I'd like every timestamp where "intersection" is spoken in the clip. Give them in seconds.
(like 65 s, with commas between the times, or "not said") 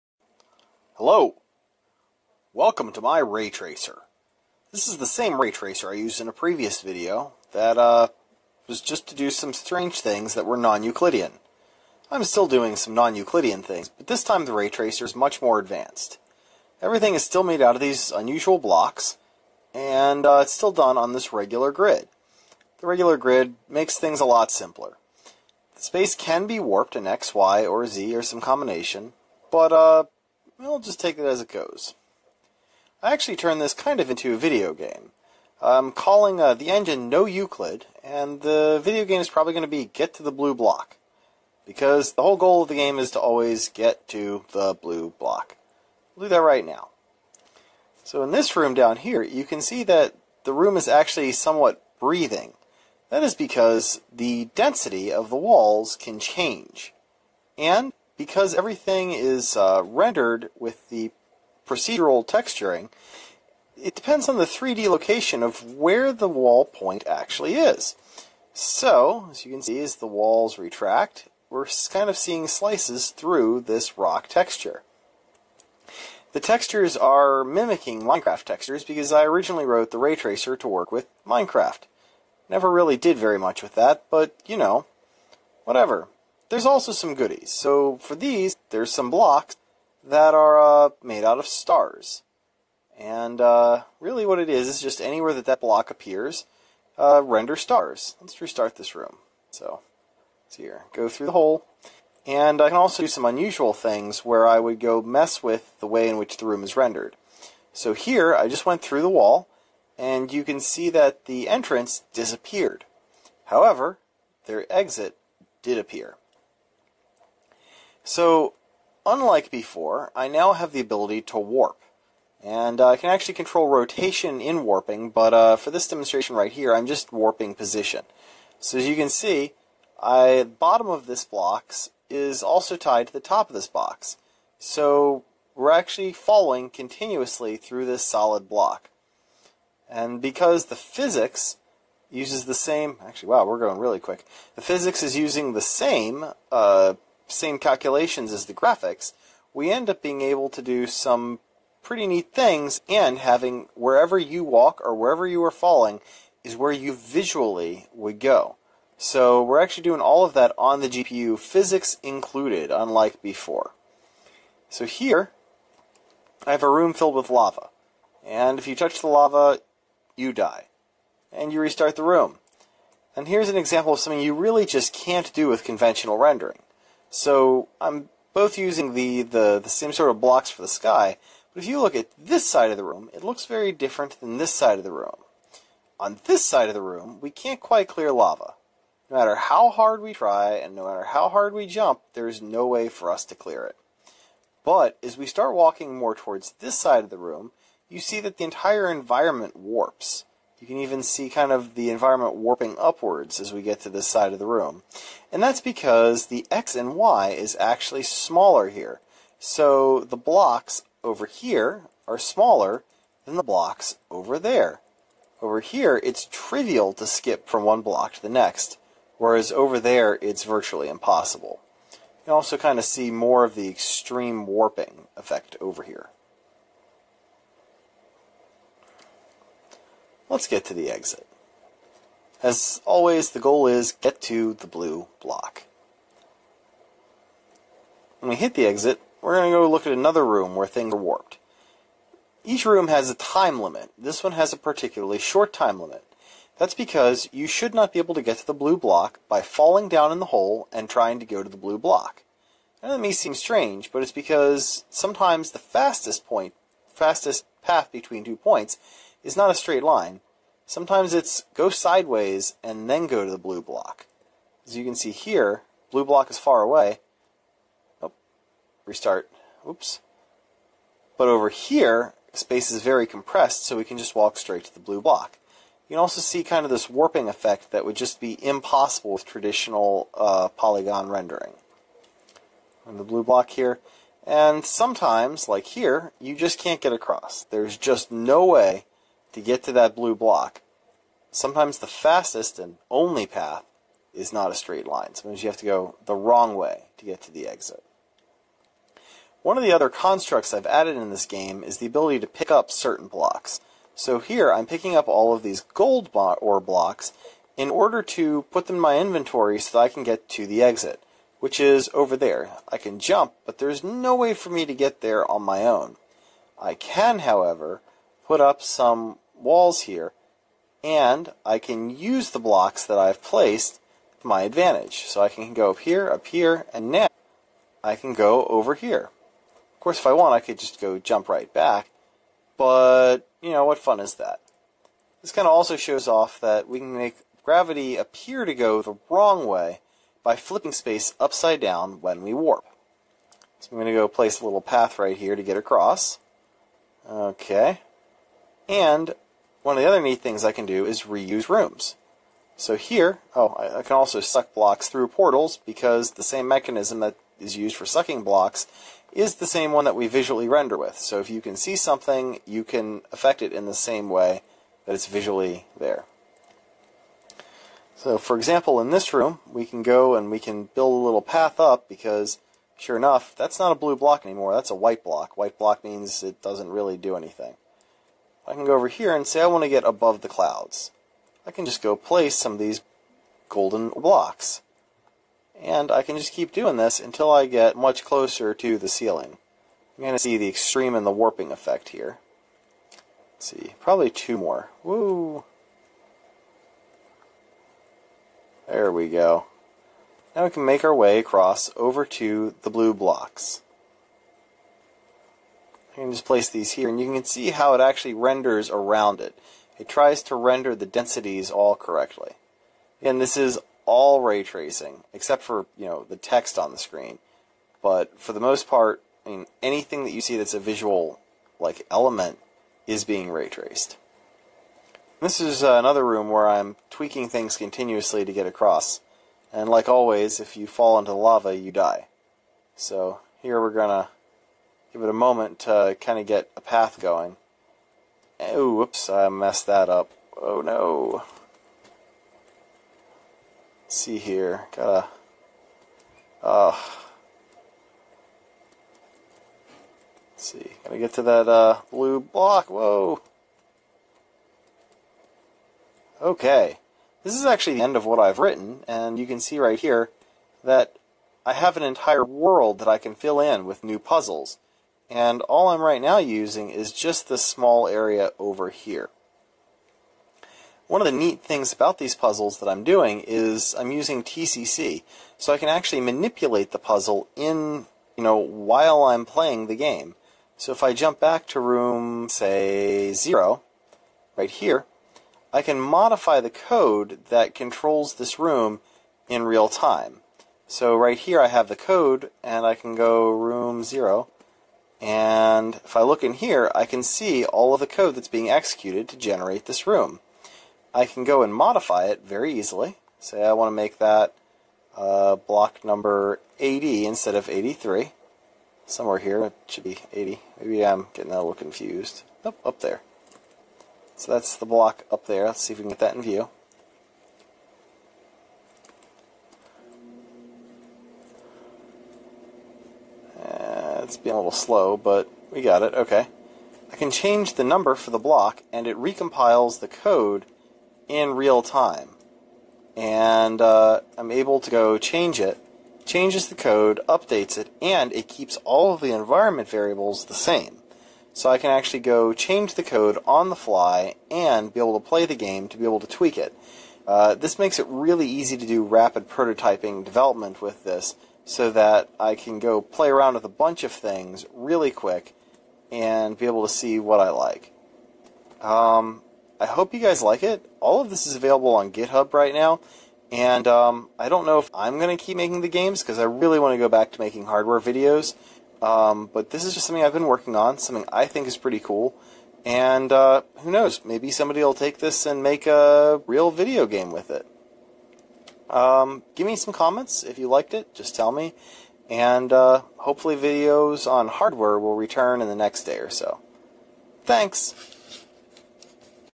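not said.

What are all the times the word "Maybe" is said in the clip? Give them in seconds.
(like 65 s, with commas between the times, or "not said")
510 s, 574 s.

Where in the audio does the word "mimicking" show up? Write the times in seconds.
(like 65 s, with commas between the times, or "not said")
77 s.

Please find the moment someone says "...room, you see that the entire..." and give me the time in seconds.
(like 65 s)
197 s.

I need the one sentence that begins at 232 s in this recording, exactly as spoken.
As always, the goal is get to the blue block.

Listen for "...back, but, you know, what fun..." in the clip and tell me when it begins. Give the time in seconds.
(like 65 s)
331 s.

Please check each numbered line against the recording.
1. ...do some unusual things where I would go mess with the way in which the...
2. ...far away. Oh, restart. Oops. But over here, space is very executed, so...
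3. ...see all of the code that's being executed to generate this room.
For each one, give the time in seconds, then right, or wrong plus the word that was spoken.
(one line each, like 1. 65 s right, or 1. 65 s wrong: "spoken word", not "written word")
1. 103 s right
2. 266 s wrong: "compressed", not "executed"
3. 497 s right.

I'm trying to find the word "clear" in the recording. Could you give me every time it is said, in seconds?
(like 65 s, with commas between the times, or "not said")
187 s, 193 s.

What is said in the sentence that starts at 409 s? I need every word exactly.
It tries to render the densities all correctly.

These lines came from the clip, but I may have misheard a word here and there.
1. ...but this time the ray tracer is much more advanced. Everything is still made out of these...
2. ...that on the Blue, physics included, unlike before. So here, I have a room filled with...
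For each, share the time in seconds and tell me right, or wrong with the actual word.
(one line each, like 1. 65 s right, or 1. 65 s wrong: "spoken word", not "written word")
1. 13 s right
2. 160 s wrong: "GPU", not "Blue".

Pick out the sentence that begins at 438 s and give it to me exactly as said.
Oh, whoops, I messed that up.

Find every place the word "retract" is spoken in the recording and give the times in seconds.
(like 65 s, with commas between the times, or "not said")
70 s.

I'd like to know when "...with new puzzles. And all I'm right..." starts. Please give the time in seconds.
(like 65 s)
463 s.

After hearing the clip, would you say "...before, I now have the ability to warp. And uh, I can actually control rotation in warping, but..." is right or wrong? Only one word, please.
right.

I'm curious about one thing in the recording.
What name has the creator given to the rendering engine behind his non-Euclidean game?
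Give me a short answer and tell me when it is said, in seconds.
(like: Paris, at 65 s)
No Euclid, at 37 s.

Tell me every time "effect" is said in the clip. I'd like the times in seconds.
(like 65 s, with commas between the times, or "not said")
225 s, 277 s, 391 s.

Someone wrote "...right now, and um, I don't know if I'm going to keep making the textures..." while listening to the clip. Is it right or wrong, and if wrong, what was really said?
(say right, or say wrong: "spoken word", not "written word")
wrong: "games", not "textures".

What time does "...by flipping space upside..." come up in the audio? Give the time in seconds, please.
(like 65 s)
340 s.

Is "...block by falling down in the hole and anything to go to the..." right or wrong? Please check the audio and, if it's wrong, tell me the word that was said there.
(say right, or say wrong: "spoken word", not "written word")
wrong: "trying", not "anything".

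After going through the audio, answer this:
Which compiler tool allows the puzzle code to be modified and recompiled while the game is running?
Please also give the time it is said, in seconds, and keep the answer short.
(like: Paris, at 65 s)
TCC, at 474 s.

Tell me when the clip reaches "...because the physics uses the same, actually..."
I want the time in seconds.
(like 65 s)
140 s.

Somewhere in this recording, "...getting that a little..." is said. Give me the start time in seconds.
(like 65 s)
511 s.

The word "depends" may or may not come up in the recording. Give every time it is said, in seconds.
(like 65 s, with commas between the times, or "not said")
63 s.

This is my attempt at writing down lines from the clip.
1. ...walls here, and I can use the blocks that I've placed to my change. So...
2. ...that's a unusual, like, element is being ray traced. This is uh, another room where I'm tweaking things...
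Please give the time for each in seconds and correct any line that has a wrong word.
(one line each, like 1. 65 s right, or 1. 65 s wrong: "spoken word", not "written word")
1. 319 s wrong: "advantage", not "change"
2. 420 s wrong: "visual", not "unusual".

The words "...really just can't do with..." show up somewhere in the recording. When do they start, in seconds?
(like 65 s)
174 s.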